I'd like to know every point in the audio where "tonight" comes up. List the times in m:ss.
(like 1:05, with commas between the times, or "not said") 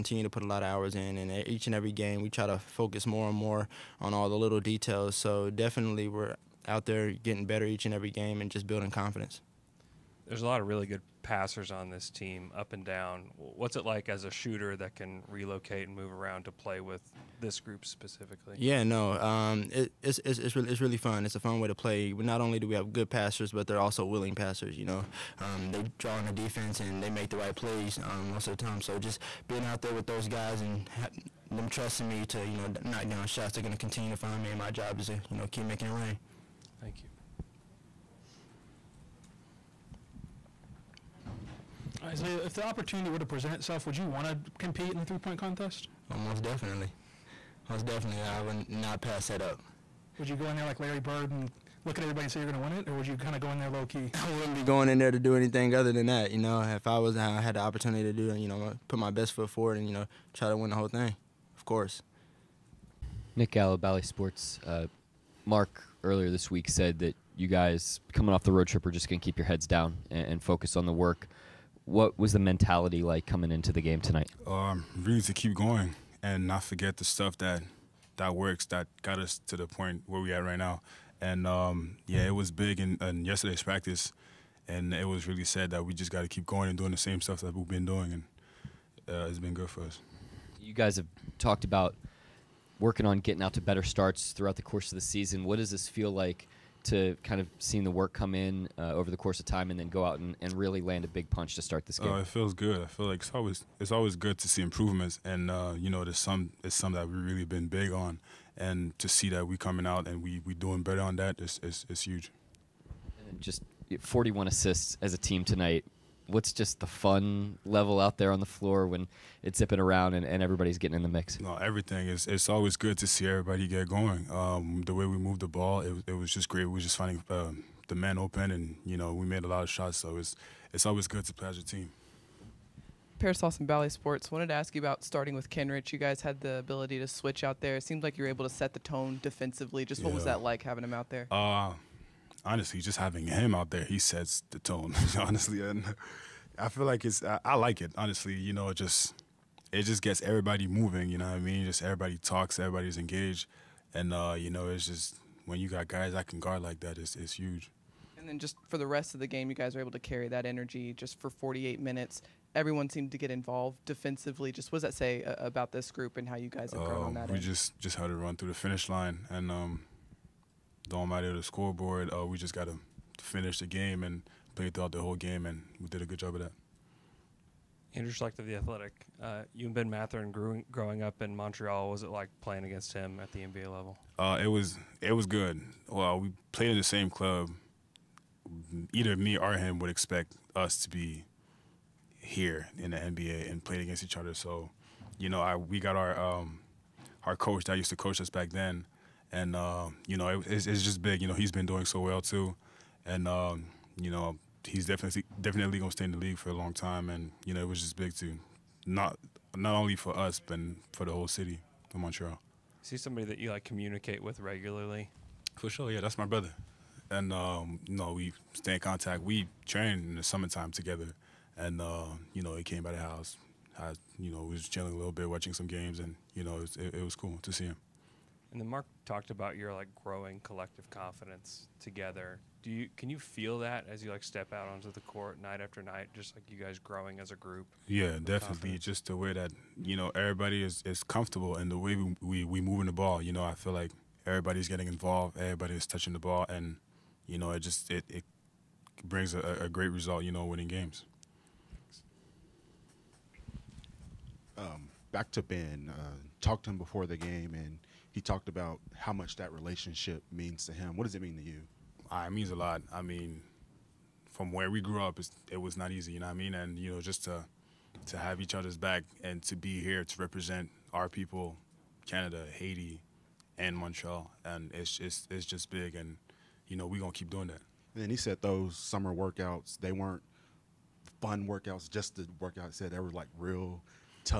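1:13, 1:55.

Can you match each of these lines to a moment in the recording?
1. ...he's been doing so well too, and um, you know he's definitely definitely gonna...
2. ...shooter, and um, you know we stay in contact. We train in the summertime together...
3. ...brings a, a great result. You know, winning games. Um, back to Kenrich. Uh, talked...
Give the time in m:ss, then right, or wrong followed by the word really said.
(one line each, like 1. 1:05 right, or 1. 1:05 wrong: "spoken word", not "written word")
1. 3:21 right
2. 3:36 wrong: "brother", not "shooter"
3. 4:09 wrong: "Ben", not "Kenrich".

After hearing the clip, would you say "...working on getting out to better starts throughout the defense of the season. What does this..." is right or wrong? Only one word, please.
wrong.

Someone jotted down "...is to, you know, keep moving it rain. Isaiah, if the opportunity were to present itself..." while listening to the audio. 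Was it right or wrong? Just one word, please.
wrong.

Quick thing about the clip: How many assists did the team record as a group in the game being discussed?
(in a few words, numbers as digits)
41.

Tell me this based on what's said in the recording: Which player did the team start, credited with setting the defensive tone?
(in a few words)
Kenrich.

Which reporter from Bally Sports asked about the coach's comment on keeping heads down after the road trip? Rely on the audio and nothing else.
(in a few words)
Nick Gallo.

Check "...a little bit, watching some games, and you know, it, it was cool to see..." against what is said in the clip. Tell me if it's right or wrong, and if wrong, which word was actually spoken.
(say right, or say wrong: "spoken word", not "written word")
right.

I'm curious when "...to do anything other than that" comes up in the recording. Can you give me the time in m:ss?
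0:55.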